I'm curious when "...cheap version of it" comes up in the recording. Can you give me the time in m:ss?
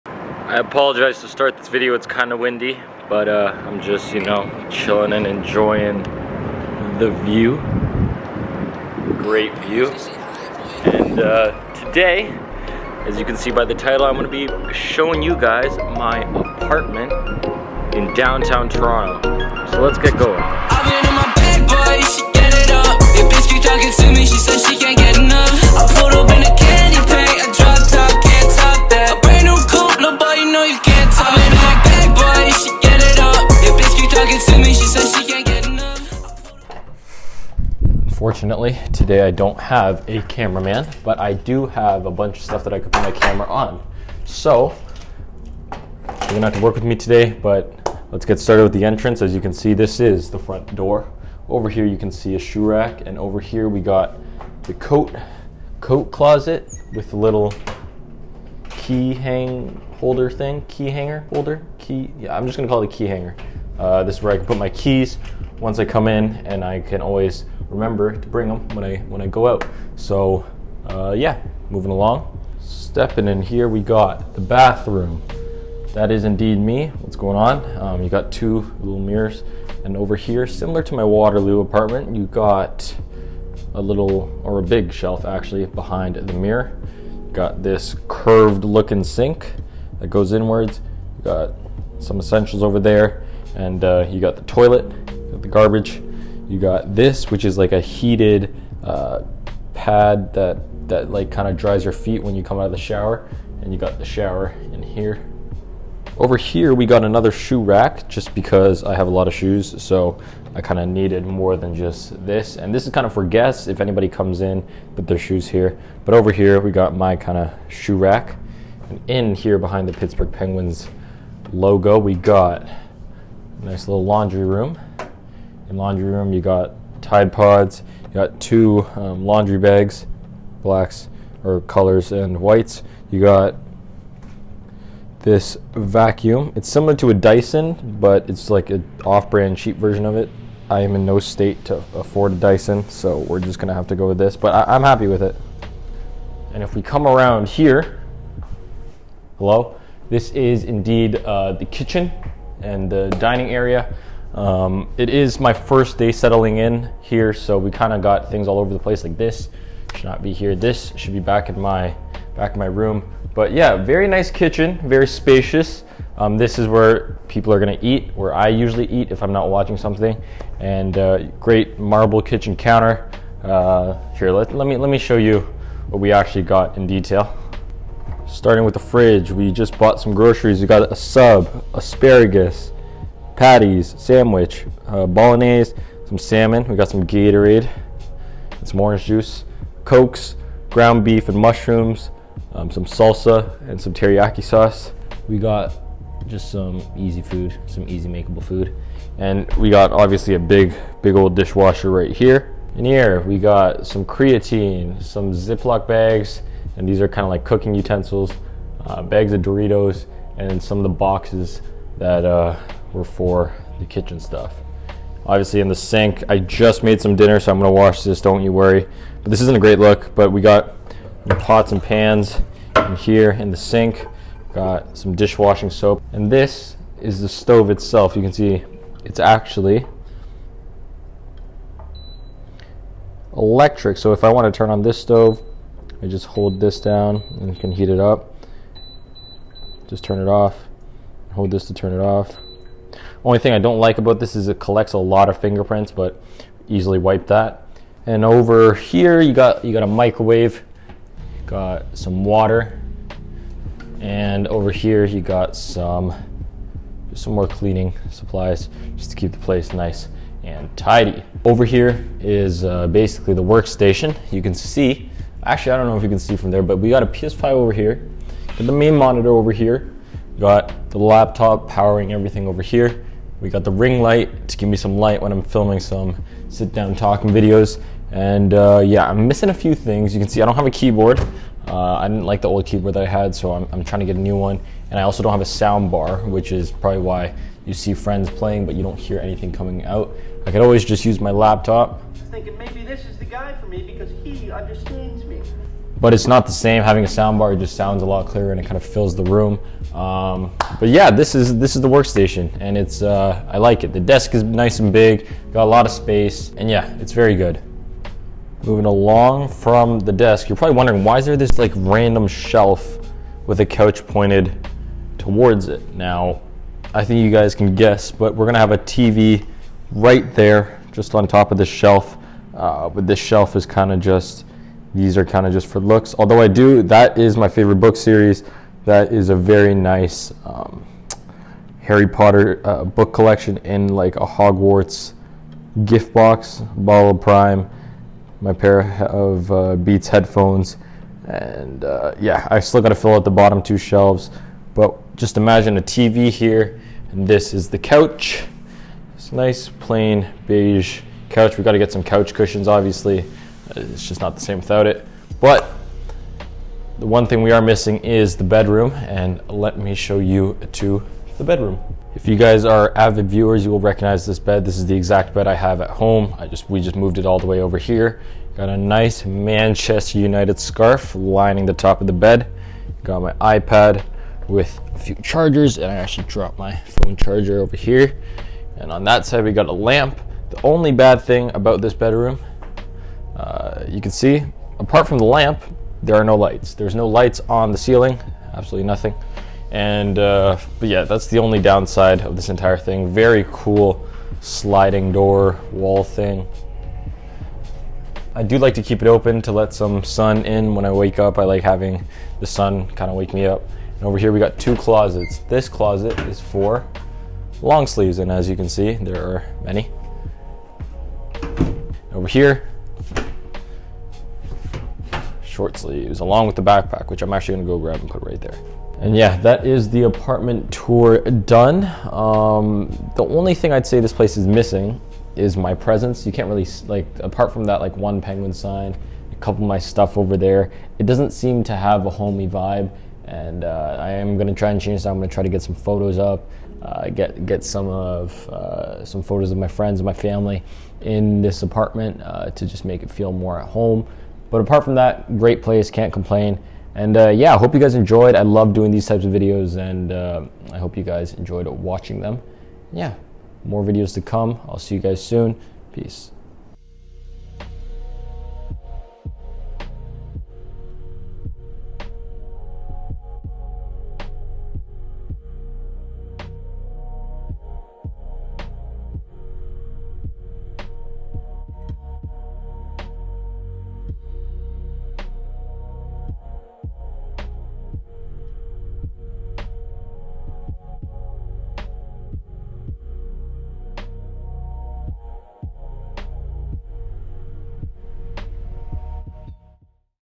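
2:19.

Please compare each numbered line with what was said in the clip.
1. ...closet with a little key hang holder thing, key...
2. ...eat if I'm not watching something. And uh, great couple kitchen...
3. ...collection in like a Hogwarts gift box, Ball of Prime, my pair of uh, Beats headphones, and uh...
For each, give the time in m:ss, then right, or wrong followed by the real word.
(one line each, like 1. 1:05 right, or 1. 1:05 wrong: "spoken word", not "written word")
1. 0:56 right
2. 2:48 wrong: "marble", not "couple"
3. 5:33 right.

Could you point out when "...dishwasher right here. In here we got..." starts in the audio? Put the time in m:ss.
3:21.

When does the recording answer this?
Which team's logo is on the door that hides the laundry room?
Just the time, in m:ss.
1:59.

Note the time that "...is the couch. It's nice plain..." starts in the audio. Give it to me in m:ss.
5:47.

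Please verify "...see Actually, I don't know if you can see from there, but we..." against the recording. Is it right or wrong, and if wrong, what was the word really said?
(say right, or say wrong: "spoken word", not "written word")
right.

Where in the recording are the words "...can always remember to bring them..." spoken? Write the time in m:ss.
1:06.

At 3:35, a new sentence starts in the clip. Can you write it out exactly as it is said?
Obviously in the sink, I just made some dinner, so I'm gonna wash this, don't you worry.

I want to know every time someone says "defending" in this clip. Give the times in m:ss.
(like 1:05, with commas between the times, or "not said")
not said.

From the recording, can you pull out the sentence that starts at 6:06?
I just We just moved it all the way over here.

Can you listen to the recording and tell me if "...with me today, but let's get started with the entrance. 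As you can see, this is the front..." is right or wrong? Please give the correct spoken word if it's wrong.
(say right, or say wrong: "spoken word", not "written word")
right.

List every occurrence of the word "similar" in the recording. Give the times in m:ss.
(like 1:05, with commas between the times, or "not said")
1:20, 2:16.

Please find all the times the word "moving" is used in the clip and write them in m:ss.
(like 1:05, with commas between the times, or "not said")
1:11, 5:08.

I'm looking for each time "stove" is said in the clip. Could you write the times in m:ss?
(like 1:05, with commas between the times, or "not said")
3:47, 3:54.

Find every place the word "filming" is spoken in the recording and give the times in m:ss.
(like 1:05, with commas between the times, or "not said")
4:35.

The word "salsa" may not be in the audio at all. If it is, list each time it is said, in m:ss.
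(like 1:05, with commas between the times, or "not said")
3:12.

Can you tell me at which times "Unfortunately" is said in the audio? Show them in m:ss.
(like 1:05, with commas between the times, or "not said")
0:38.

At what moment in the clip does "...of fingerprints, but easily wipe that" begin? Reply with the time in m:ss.
4:05.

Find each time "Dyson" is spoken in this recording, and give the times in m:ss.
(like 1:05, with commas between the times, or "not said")
2:17, 2:22.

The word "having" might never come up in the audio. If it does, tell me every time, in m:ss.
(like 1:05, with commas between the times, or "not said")
4:56, 6:41.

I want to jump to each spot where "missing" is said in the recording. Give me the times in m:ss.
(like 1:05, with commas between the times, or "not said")
4:39, 5:57, 7:04.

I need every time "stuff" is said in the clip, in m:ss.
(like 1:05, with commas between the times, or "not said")
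0:42, 3:34, 7:09.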